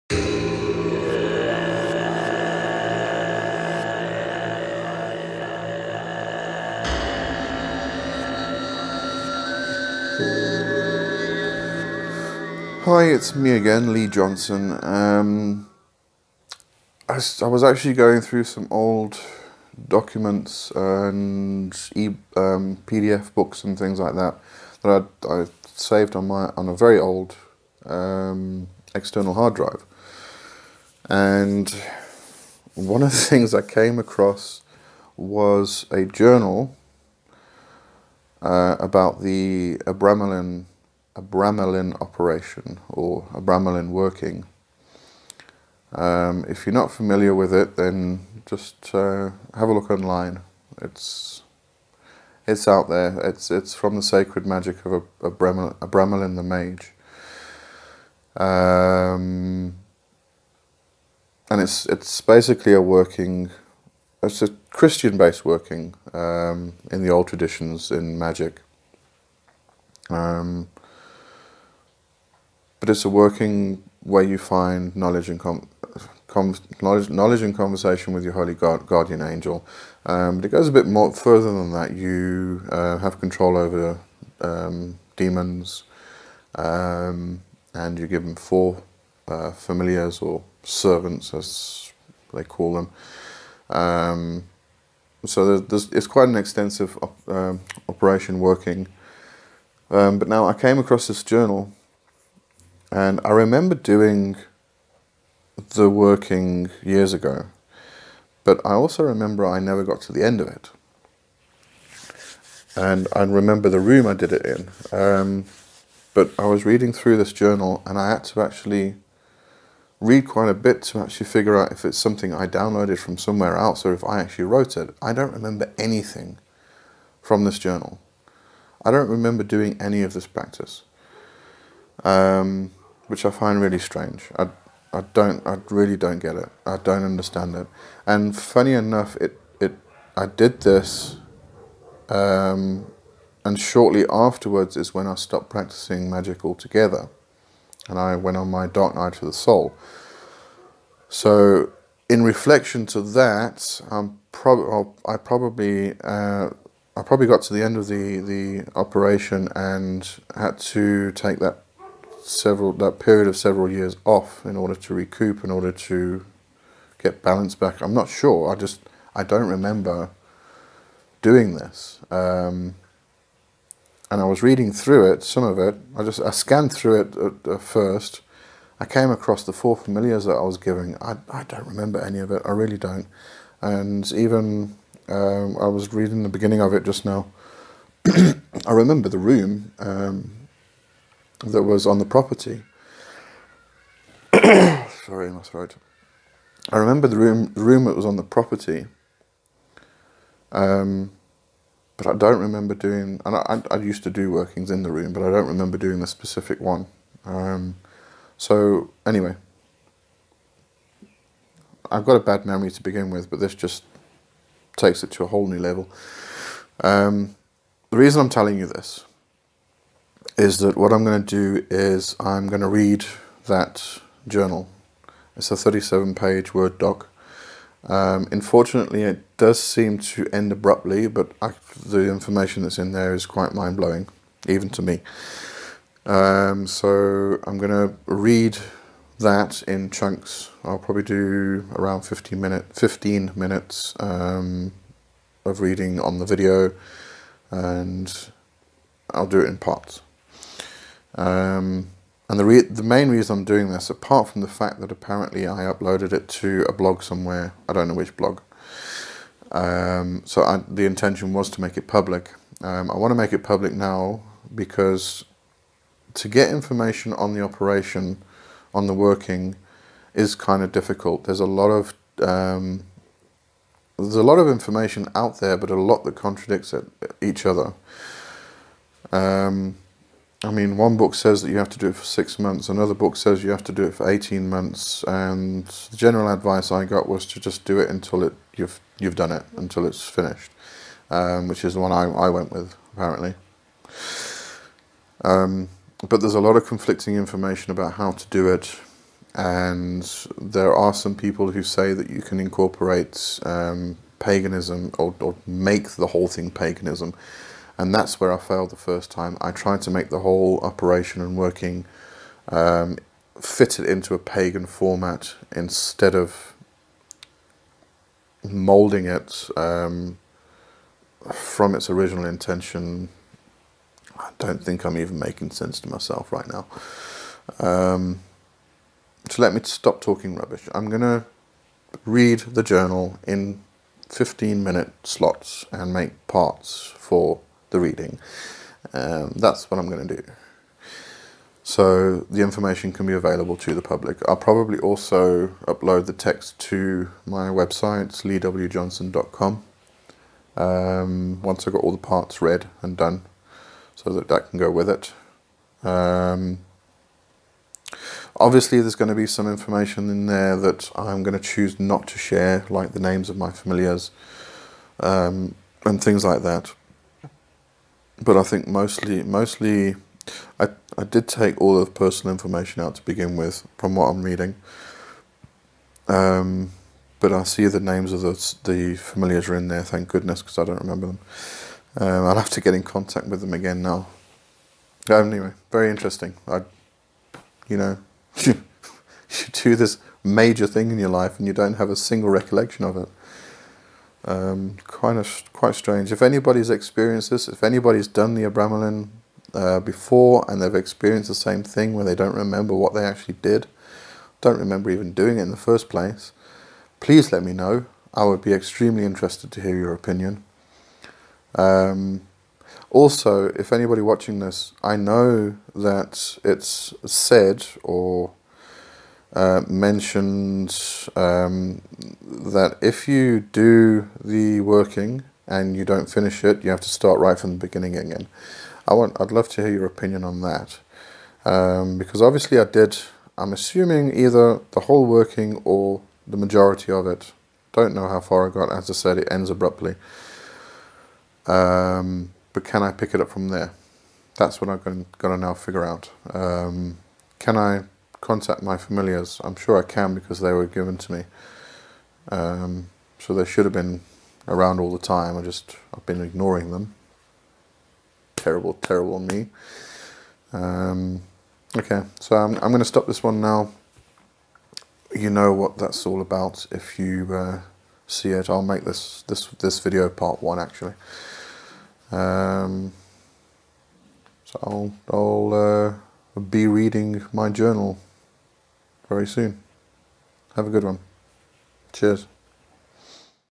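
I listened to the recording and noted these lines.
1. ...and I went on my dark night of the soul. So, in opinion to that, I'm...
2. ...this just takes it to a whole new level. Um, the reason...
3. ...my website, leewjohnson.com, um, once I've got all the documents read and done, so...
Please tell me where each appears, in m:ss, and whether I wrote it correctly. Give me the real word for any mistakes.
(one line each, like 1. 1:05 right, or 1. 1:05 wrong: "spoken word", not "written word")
1. 2:27 wrong: "reflection", not "opinion"
2. 3:33 right
3. 5:47 wrong: "parts", not "documents".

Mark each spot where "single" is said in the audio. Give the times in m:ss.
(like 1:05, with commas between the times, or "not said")
6:31.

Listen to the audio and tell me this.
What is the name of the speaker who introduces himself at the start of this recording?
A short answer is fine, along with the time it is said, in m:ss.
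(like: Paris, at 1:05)
Lee Johnson, at 0:13.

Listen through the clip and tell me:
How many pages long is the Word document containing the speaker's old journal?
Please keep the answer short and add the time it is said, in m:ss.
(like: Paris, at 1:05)
37, at 3:45.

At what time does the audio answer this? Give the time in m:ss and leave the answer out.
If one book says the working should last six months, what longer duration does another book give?
4:44.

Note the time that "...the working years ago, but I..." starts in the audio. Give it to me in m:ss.
1:45.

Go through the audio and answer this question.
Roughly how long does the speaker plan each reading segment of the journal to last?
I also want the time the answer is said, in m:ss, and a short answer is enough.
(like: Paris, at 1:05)
15 minutes, at 4:02.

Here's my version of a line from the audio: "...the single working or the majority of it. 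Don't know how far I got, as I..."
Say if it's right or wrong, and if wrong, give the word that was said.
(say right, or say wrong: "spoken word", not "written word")
wrong: "whole", not "single".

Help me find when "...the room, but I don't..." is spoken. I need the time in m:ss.
3:24.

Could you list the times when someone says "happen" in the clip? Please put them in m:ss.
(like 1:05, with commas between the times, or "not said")
not said.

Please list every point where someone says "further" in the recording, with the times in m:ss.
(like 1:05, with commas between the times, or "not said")
1:21.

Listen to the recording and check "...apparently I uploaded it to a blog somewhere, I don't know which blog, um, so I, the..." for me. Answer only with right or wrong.
right.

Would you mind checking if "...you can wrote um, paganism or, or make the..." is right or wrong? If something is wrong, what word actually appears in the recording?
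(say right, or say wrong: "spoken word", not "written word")
wrong: "incorporate", not "wrote".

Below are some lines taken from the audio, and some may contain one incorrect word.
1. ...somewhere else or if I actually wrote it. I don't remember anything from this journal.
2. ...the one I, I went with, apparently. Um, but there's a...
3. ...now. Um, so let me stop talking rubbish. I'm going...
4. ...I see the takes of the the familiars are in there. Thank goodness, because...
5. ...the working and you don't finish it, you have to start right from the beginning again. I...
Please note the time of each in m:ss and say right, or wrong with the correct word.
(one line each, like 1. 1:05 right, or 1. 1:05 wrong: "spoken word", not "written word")
1. 2:03 right
2. 4:51 right
3. 5:26 right
4. 6:17 wrong: "names", not "takes"
5. 7:04 right.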